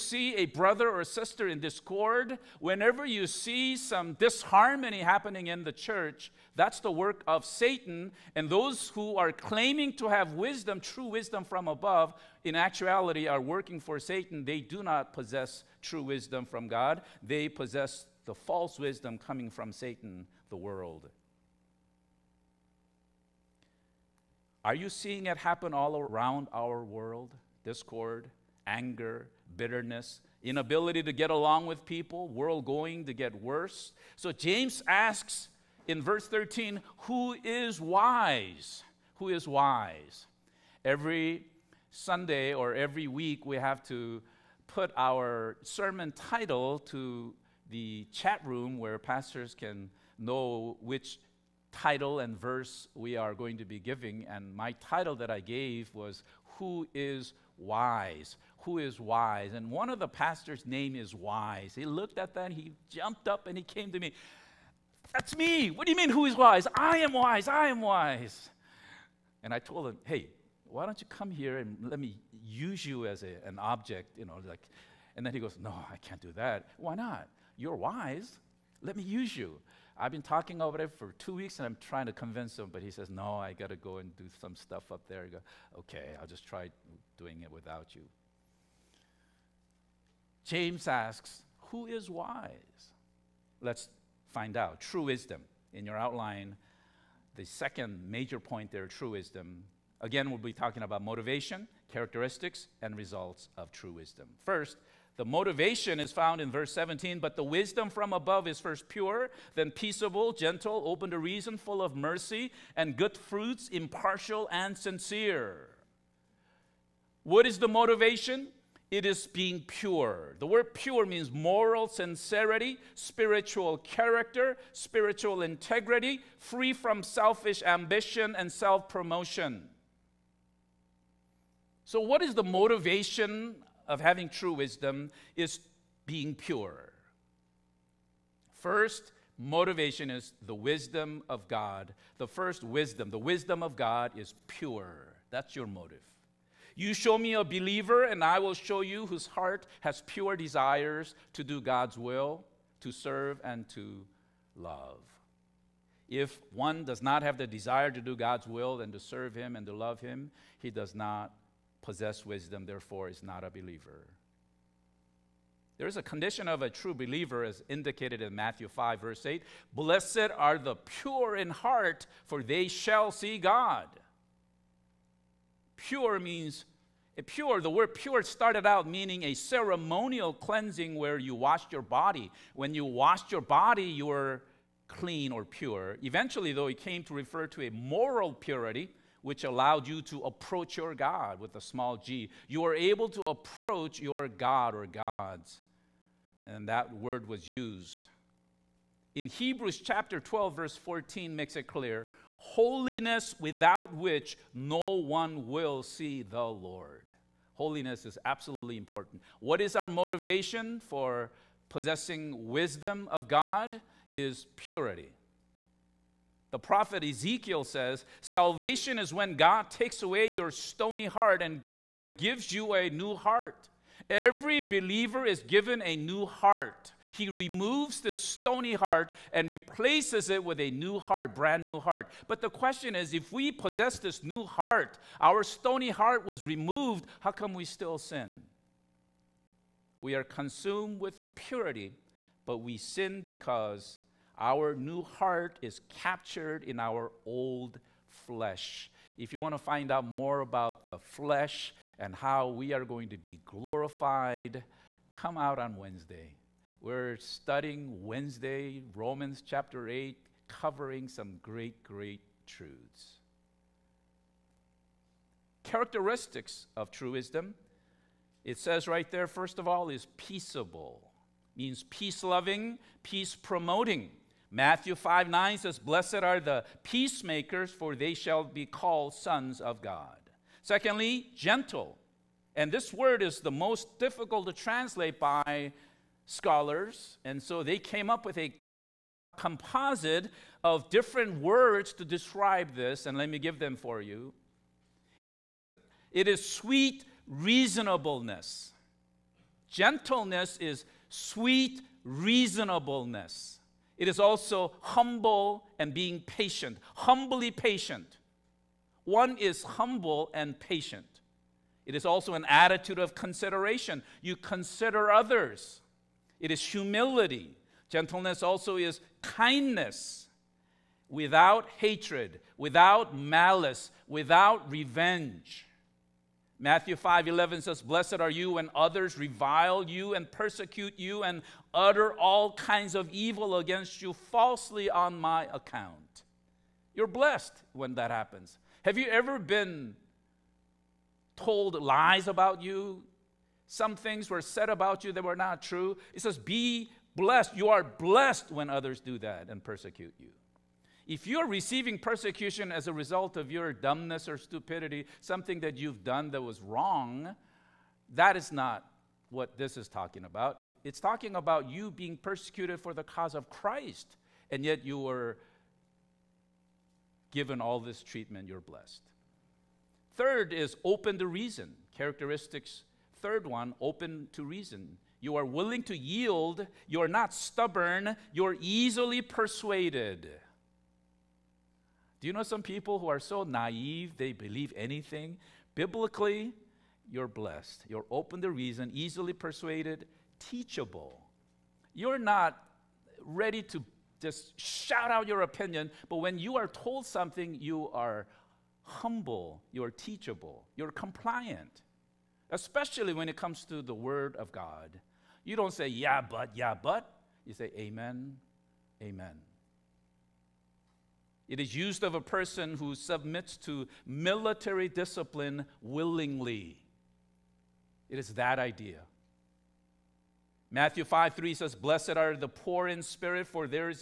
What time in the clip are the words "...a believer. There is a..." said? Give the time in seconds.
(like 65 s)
163 s.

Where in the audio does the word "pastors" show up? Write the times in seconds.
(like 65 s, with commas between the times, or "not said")
48 s, 60 s.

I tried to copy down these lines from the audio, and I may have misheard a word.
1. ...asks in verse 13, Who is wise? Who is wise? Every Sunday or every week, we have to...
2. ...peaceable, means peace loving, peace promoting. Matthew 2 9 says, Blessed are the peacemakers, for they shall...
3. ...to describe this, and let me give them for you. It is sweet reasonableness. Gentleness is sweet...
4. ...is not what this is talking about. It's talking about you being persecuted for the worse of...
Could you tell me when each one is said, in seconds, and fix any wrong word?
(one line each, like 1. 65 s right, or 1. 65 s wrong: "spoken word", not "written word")
1. 34 s right
2. 270 s wrong: "5", not "2"
3. 291 s right
4. 358 s wrong: "cause", not "worse".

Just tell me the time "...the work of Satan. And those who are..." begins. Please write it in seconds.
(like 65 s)
6 s.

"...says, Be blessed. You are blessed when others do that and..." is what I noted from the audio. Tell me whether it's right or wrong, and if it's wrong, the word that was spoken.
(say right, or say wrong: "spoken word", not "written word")
right.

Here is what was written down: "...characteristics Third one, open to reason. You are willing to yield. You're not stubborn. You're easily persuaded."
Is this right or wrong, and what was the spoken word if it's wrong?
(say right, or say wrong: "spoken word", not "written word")
right.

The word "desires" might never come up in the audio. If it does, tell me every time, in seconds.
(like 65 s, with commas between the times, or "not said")
150 s, 157 s.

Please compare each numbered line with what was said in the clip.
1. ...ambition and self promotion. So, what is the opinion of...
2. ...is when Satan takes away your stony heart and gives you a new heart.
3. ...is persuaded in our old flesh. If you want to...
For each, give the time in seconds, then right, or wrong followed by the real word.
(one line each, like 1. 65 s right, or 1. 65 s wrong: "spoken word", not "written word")
1. 127 s wrong: "motivation", not "opinion"
2. 218 s wrong: "God", not "Satan"
3. 245 s wrong: "captured", not "persuaded".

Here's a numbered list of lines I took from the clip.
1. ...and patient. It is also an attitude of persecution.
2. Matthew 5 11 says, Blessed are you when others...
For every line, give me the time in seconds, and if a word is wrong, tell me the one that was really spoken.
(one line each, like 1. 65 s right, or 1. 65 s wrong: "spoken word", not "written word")
1. 310 s wrong: "consideration", not "persecution"
2. 326 s right.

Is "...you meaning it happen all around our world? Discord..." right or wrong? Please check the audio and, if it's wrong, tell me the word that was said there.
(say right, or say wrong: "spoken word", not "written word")
wrong: "seeing", not "meaning".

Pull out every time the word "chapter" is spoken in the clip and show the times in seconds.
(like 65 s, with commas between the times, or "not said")
199 s, 259 s.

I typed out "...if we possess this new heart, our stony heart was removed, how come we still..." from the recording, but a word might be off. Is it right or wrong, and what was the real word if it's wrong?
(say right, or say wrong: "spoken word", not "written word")
right.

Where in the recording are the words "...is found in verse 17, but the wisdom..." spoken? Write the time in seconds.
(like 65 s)
105 s.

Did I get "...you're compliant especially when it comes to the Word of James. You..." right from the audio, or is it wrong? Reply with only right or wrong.
wrong.